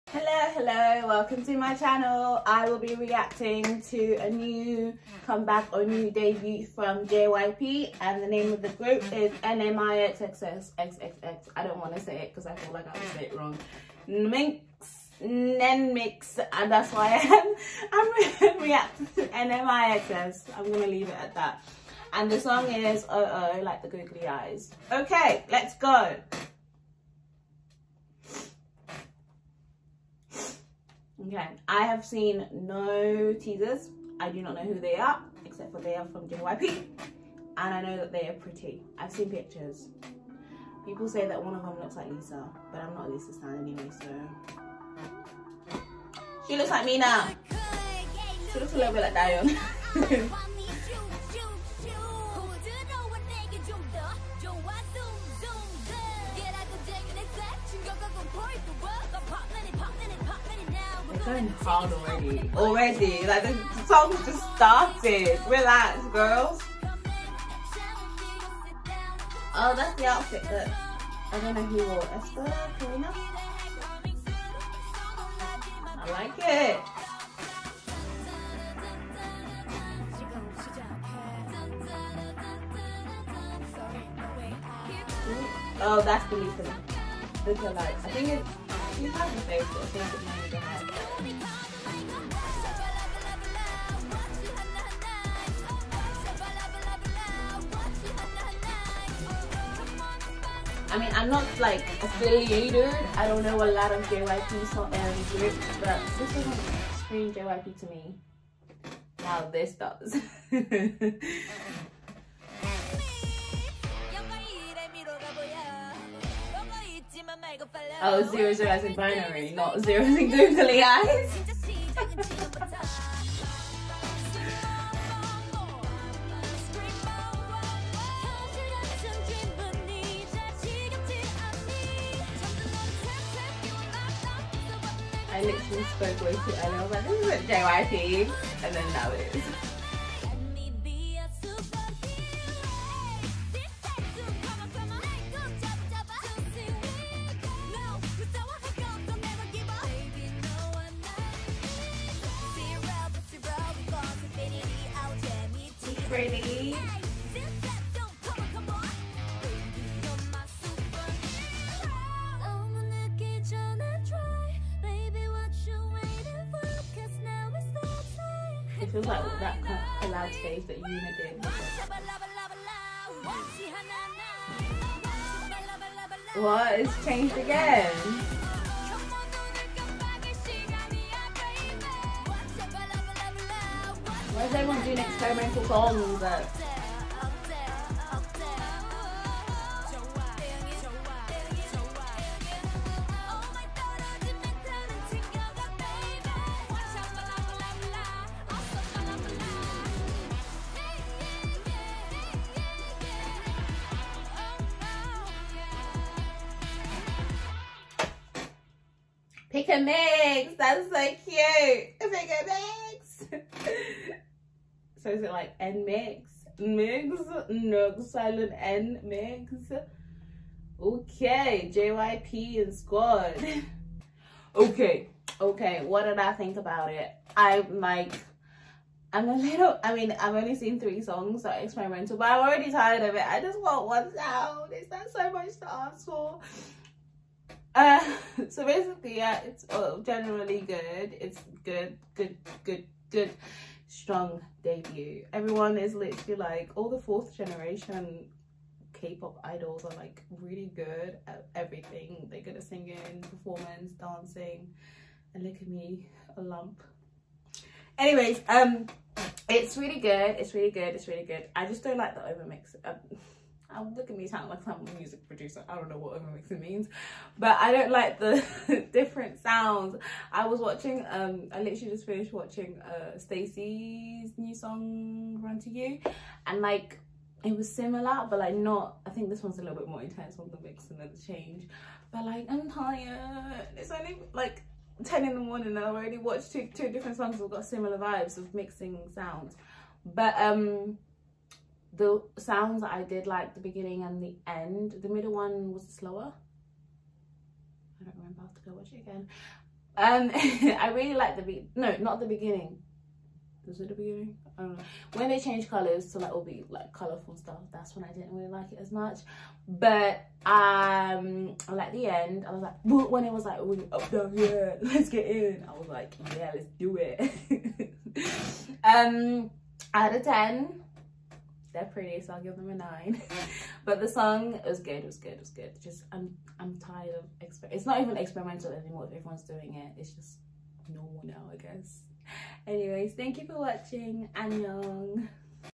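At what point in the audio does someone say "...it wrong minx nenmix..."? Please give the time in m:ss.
0:13.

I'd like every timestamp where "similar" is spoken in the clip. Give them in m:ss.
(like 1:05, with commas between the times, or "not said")
4:37, 4:47.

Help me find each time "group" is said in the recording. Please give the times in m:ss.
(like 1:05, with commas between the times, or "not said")
0:08.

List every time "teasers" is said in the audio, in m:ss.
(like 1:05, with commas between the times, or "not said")
0:33.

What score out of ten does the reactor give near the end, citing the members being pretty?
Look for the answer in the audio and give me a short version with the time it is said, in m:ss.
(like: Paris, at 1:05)
9, at 5:22.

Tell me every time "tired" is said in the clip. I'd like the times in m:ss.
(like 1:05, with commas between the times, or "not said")
3:52, 4:42, 5:26.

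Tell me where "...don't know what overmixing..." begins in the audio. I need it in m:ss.
4:25.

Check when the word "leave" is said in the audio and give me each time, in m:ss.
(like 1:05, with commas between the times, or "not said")
0:20.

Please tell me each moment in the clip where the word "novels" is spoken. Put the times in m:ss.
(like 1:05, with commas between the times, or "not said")
not said.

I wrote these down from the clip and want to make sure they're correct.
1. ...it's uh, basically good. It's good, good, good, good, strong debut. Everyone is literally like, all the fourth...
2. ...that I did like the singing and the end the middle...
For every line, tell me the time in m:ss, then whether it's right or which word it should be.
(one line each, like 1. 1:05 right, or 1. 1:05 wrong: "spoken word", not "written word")
1. 3:59 wrong: "generally", not "basically"
2. 4:52 wrong: "beginning", not "singing".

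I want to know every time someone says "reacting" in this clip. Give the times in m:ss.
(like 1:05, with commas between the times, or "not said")
0:02, 0:18.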